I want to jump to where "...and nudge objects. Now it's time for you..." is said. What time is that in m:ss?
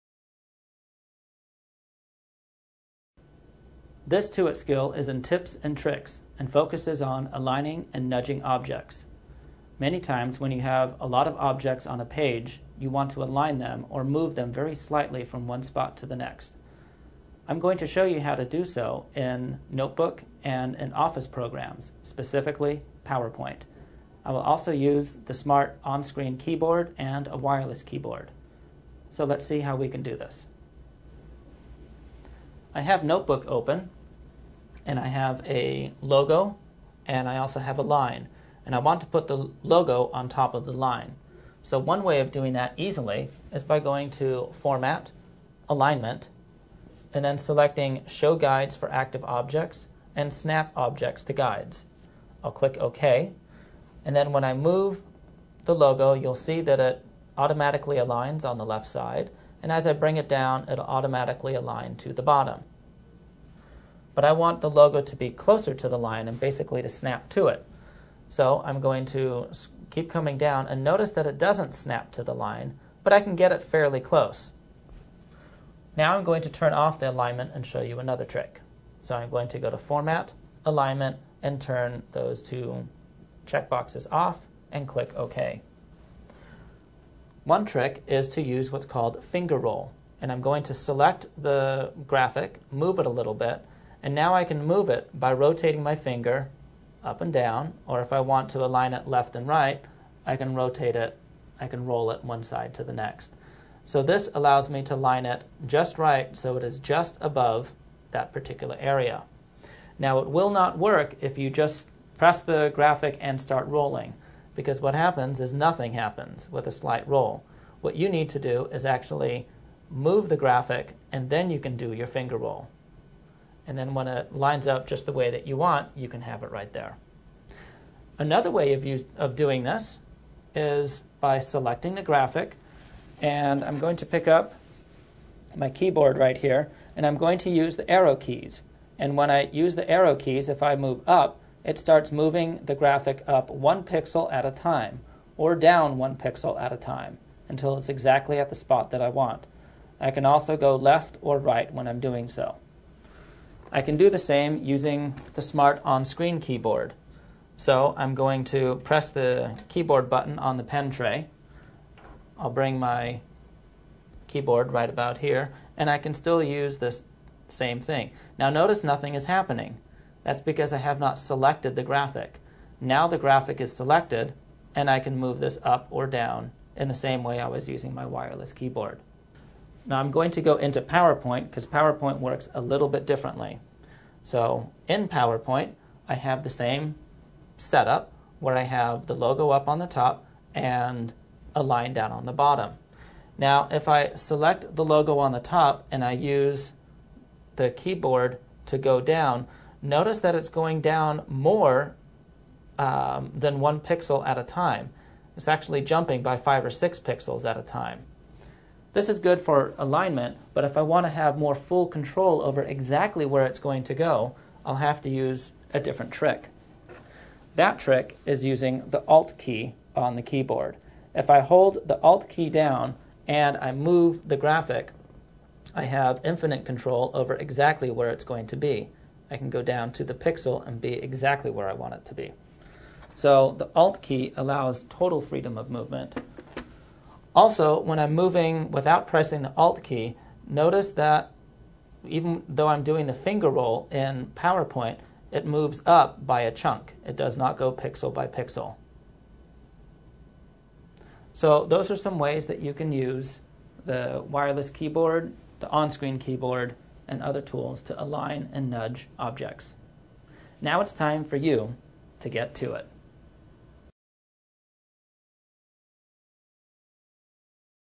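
4:18.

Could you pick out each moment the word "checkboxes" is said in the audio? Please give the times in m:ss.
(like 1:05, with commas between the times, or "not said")
1:23.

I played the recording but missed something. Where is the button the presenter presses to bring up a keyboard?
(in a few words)
pen tray.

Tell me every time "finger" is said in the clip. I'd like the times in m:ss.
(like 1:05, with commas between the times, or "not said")
1:29, 1:35, 2:02, 4:03.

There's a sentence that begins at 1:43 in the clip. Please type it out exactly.
So this allows me to line it just right so it is just above that particular area.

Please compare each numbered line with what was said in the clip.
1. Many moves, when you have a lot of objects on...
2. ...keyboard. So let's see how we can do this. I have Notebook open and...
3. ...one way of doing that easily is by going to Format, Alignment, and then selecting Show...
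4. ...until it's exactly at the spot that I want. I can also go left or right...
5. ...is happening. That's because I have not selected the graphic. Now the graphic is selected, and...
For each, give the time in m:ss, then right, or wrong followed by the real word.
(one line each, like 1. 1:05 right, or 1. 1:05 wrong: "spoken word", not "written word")
1. 0:09 wrong: "times", not "moves"
2. 0:27 right
3. 0:41 right
4. 2:27 right
5. 2:49 right.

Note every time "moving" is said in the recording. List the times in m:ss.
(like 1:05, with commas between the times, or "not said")
2:22, 3:58.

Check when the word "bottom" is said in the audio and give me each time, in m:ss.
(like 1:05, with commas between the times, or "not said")
1:02, 3:12.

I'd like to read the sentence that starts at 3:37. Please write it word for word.
That trick is using the Alt key on the keyboard.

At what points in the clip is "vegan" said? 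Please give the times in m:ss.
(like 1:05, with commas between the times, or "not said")
not said.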